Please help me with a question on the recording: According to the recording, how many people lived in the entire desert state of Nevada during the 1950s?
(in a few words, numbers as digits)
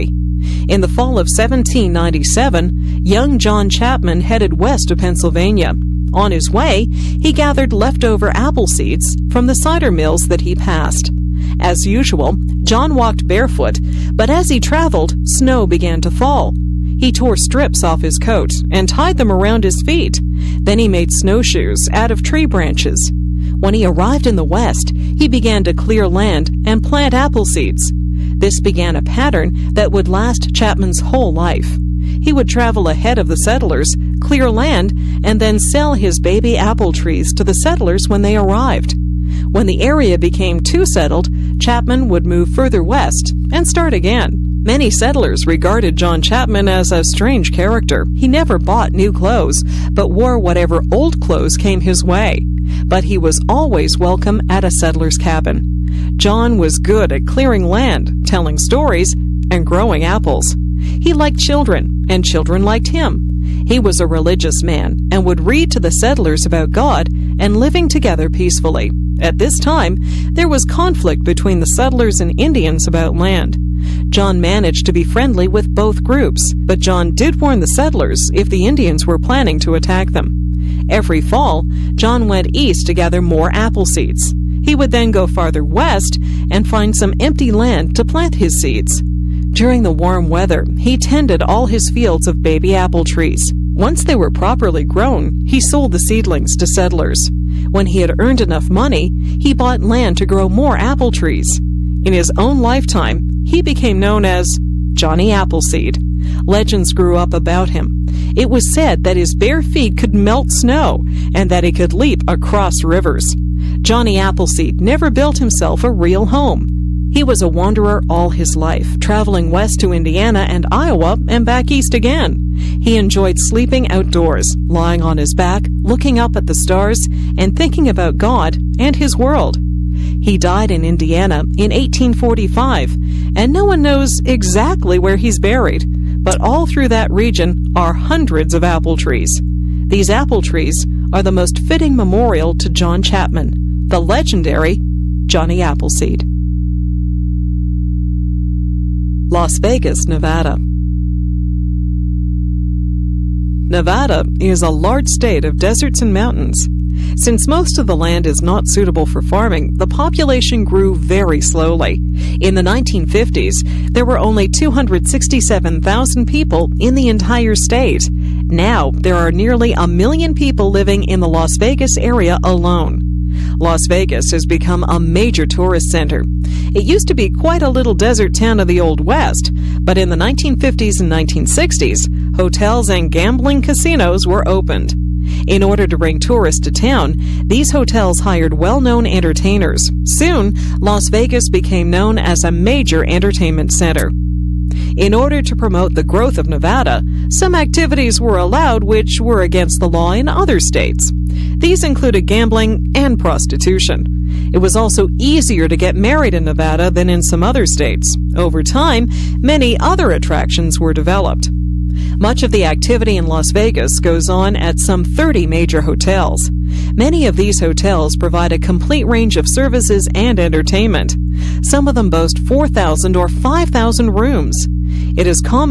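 267,000.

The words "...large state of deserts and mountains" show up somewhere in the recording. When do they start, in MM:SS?
02:34.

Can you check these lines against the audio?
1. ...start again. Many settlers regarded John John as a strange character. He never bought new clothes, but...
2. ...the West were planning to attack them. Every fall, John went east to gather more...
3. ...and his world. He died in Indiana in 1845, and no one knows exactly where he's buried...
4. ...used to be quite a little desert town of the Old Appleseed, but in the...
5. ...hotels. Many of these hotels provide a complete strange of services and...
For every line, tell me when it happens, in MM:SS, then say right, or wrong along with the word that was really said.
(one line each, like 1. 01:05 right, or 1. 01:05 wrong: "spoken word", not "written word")
1. 00:43 wrong: "Chapman", not "John"
2. 01:18 wrong: "Indians", not "West"
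3. 02:08 right
4. 02:56 wrong: "West", not "Appleseed"
5. 03:35 wrong: "range", not "strange".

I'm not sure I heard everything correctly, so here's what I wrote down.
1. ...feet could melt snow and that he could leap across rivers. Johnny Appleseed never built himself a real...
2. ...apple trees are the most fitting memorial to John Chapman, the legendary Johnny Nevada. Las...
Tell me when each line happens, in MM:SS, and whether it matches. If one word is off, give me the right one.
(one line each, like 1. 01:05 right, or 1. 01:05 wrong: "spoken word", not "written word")
1. 01:49 right
2. 02:20 wrong: "Appleseed", not "Nevada".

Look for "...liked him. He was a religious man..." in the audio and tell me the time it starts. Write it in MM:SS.
01:02.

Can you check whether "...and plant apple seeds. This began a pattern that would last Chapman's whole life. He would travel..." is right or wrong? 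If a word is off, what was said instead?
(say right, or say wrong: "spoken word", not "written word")
right.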